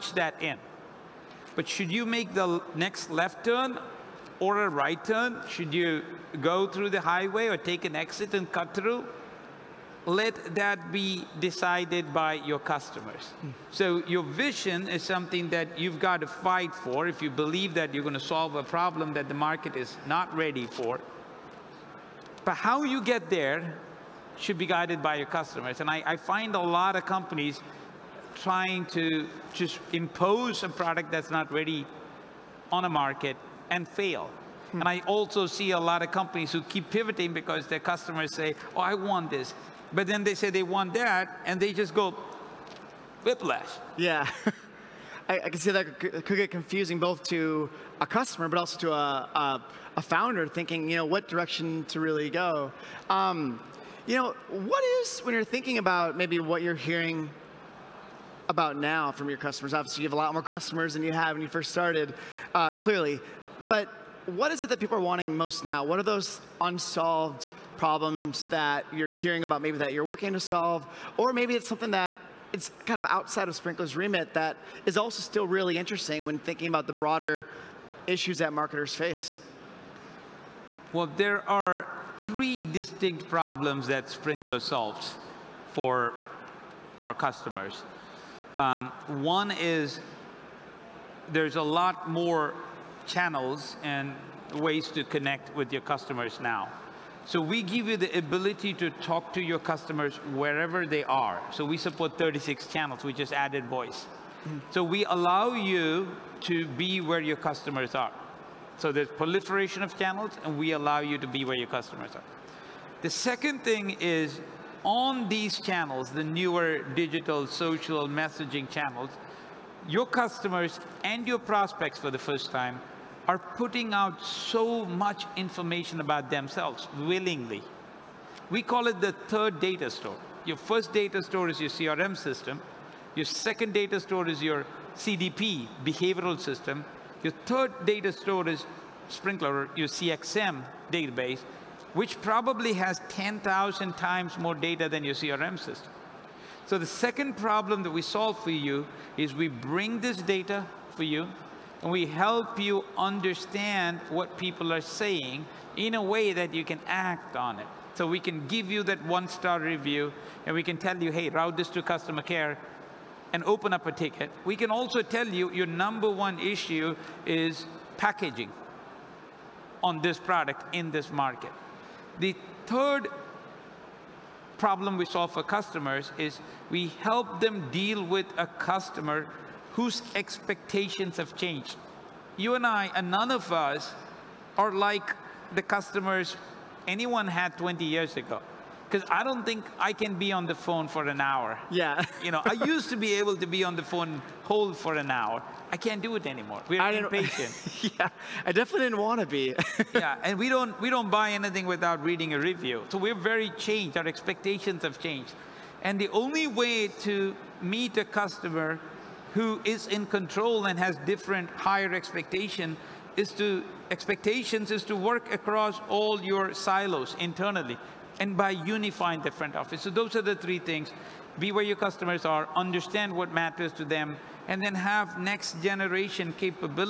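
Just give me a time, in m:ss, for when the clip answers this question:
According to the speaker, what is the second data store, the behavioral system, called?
2:14.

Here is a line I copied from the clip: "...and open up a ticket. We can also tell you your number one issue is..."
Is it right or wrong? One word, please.
right.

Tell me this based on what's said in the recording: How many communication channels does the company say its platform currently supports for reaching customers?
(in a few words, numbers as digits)
36.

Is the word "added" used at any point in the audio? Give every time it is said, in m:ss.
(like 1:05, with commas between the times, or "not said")
1:43.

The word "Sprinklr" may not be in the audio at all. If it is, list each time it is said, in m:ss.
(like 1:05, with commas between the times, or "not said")
1:13, 1:24, 2:19.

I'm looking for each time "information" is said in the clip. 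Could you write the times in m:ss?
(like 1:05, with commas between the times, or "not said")
2:05.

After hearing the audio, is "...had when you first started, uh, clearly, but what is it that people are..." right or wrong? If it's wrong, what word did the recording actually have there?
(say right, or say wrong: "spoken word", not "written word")
right.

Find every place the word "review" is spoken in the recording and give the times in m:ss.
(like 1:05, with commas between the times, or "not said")
2:39, 3:22.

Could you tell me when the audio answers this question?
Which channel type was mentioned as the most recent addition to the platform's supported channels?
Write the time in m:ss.
1:43.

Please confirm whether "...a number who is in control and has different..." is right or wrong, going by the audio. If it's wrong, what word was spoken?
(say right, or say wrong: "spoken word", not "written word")
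wrong: "customer", not "number".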